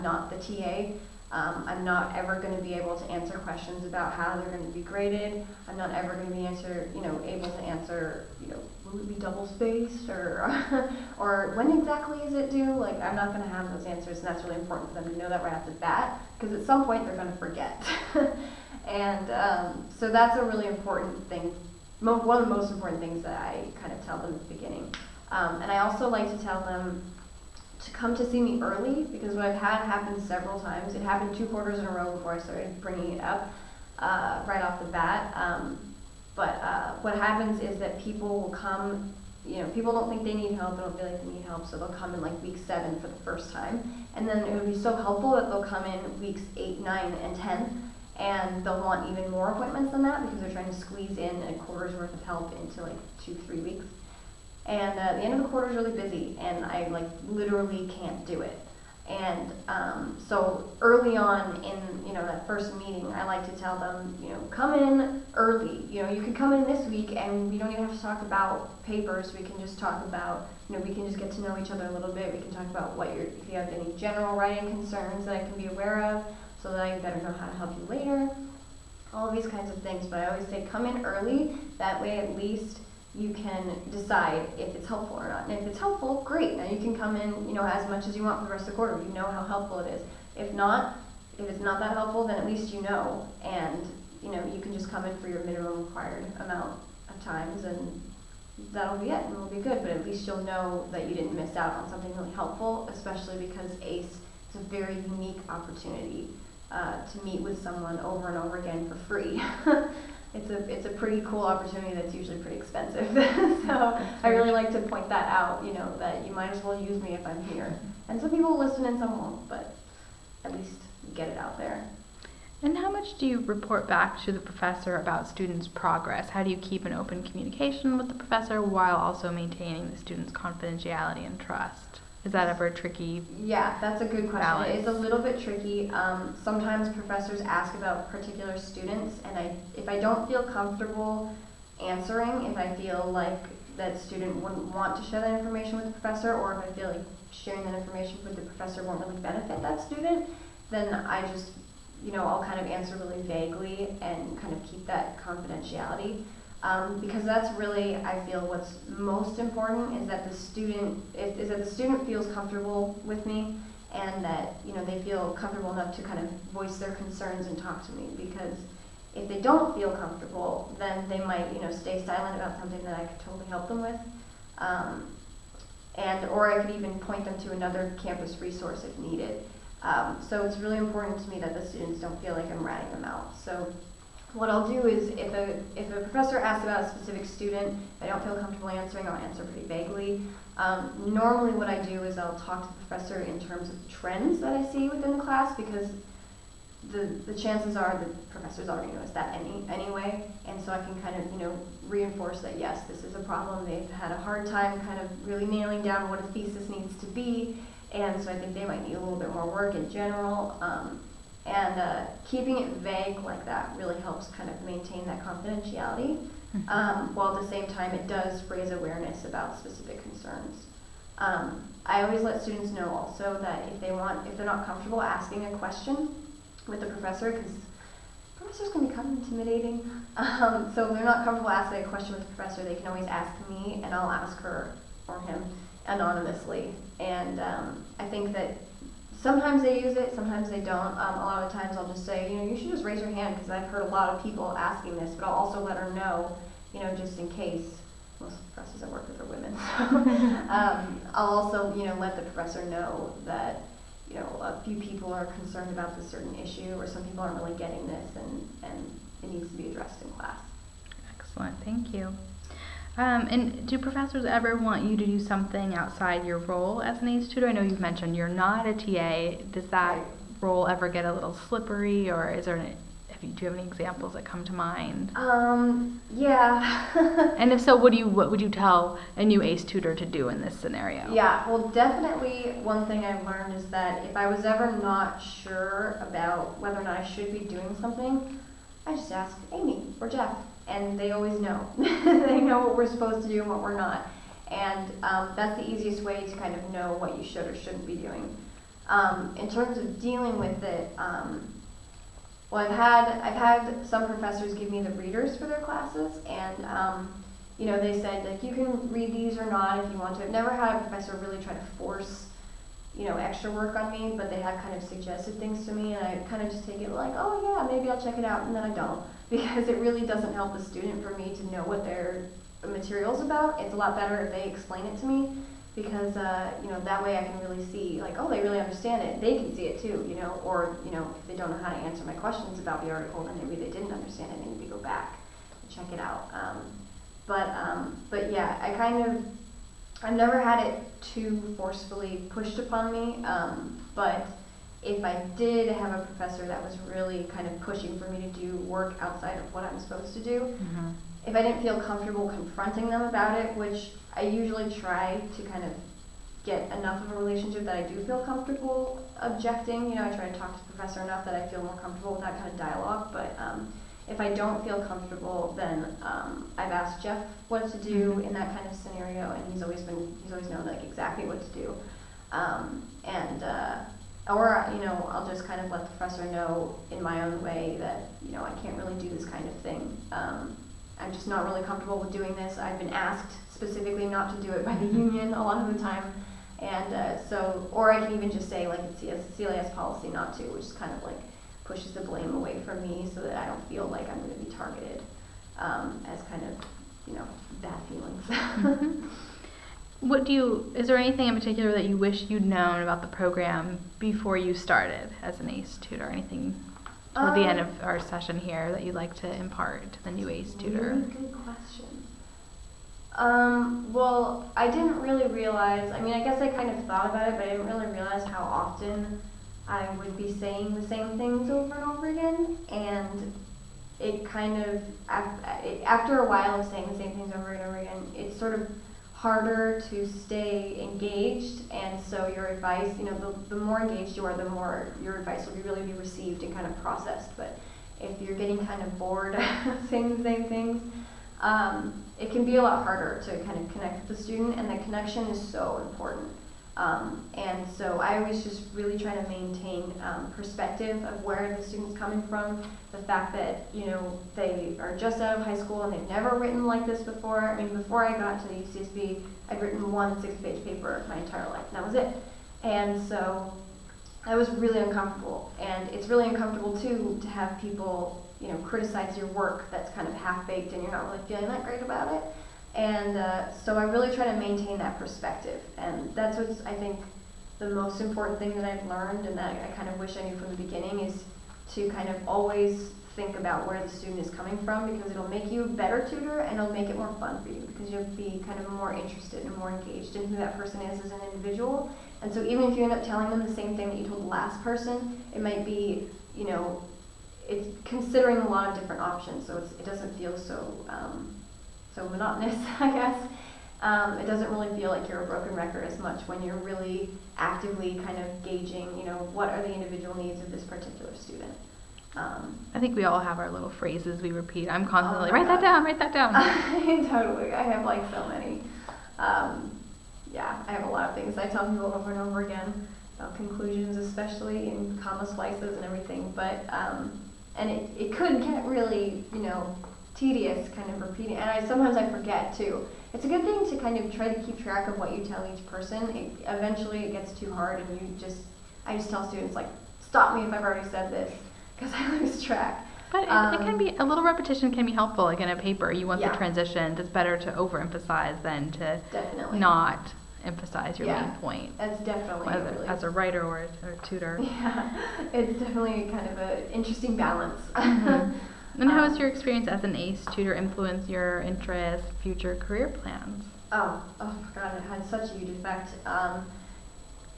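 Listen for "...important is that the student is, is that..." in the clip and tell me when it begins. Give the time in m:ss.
2:39.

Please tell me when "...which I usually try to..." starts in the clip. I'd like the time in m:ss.
5:53.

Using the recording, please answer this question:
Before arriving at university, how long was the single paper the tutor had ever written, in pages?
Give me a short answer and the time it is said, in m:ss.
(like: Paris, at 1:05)
6 pages, at 7:40.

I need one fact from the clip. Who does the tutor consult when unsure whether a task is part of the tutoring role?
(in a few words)
Amy or Jeff.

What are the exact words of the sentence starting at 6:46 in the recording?
Anything um, at the end um, of our session here that you'd like to impart to the new ACE tutor?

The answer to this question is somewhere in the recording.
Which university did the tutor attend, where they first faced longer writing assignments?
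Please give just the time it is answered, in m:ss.
7:38.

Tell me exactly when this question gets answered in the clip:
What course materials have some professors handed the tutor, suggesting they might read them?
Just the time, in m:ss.
5:04.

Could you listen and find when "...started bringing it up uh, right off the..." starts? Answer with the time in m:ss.
0:32.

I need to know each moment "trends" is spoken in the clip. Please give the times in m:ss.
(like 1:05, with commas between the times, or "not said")
3:13.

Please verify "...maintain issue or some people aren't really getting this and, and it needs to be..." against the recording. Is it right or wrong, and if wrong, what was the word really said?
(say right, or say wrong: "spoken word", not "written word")
wrong: "certain", not "maintain".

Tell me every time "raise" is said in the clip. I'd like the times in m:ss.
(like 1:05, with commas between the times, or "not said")
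3:38, 4:02.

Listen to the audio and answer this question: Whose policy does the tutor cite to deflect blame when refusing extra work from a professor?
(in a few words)
CLAS.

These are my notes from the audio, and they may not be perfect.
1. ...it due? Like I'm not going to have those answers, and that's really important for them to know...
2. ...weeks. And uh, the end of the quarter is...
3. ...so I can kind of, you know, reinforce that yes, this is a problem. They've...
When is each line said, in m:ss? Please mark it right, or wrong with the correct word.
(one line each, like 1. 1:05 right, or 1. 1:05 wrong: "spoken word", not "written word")
1. 0:12 right
2. 0:53 right
3. 3:20 right.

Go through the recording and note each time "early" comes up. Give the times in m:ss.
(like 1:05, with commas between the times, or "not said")
0:28, 1:00, 1:05, 1:21.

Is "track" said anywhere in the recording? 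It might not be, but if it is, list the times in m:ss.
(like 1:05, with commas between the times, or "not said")
8:54, 9:02.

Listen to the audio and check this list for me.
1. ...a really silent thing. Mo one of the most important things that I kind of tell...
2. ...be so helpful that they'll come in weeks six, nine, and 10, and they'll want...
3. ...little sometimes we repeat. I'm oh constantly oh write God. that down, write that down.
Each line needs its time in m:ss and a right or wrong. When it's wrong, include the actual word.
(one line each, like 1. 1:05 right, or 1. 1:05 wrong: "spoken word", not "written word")
1. 0:20 wrong: "important", not "silent"
2. 0:44 wrong: "eight", not "six"
3. 8:33 wrong: "phrases", not "sometimes".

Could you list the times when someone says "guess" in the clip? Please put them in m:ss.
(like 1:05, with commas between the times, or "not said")
6:56, 8:22.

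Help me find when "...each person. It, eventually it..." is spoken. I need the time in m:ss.
8:55.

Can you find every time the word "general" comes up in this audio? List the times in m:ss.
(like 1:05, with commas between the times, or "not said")
1:13, 3:29.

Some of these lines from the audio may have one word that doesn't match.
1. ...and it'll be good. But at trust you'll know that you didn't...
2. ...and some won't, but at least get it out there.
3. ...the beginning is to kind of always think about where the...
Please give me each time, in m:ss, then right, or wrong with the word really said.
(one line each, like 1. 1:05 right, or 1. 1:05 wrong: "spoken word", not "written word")
1. 1:39 wrong: "least", not "trust"
2. 1:58 right
3. 8:00 right.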